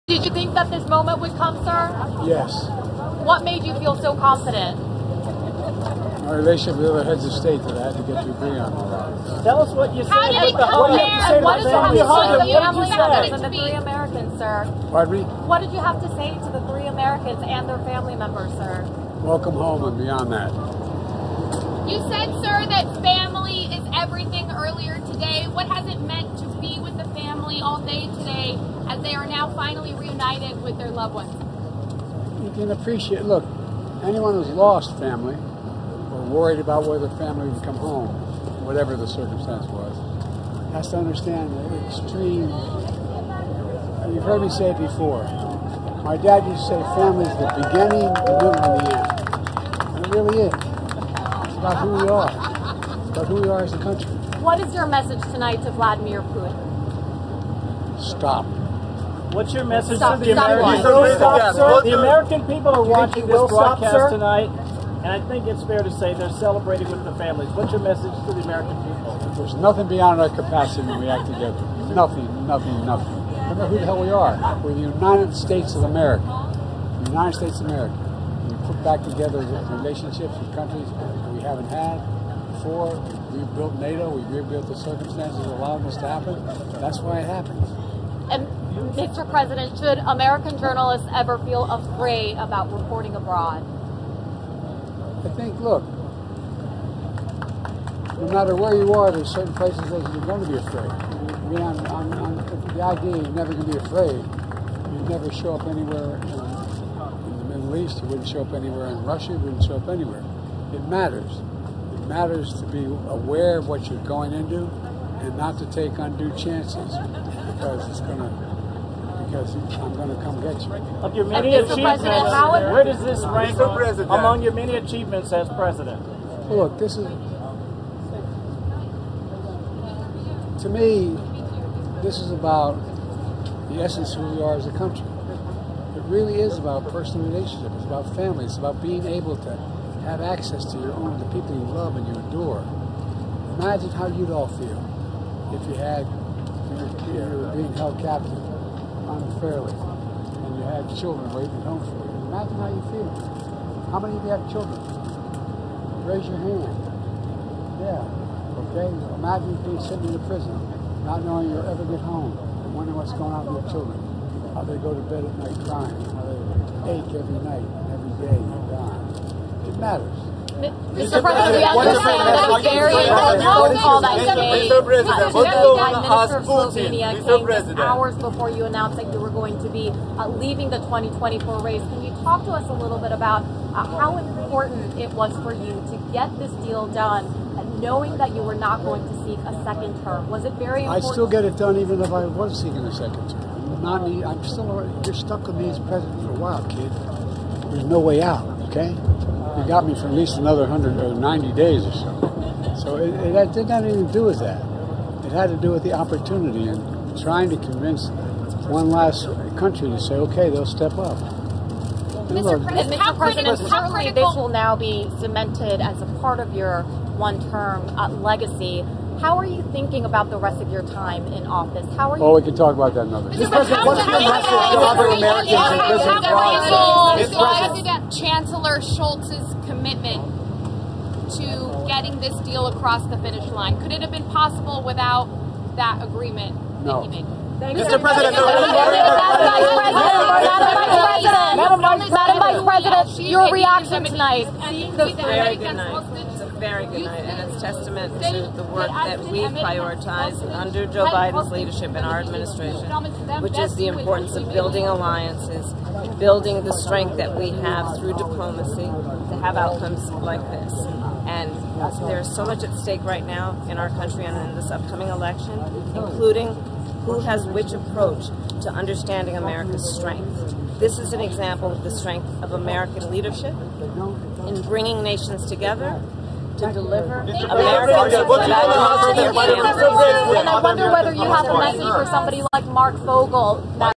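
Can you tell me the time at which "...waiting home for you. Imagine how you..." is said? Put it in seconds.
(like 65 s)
151 s.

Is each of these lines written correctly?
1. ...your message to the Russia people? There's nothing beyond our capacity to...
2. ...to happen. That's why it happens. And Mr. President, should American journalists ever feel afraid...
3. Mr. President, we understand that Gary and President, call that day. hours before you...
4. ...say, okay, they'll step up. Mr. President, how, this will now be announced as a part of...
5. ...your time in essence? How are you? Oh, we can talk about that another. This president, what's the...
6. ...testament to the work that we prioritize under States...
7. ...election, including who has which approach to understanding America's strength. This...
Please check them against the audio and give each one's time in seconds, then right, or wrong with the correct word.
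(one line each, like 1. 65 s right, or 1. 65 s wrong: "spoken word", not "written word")
1. 67 s wrong: "American", not "Russia"
2. 86 s right
3. 170 s right
4. 209 s wrong: "cemented", not "announced"
5. 220 s wrong: "office", not "essence"
6. 247 s wrong: "Joe", not "States"
7. 265 s right.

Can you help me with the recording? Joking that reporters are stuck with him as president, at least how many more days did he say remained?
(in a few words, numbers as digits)
90.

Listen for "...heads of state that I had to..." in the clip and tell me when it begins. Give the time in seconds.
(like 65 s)
7 s.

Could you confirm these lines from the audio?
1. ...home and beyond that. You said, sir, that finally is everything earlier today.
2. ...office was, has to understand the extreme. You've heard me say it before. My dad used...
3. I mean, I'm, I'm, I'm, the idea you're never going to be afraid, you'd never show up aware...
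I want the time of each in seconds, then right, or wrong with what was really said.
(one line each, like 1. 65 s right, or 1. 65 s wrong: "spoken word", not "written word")
1. 19 s wrong: "family", not "finally"
2. 39 s wrong: "circumstance", not "office"
3. 100 s wrong: "anywhere", not "aware".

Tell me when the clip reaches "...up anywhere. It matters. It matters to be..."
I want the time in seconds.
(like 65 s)
109 s.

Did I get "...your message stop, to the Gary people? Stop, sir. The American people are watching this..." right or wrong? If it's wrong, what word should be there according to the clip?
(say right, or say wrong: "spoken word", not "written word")
wrong: "American", not "Gary".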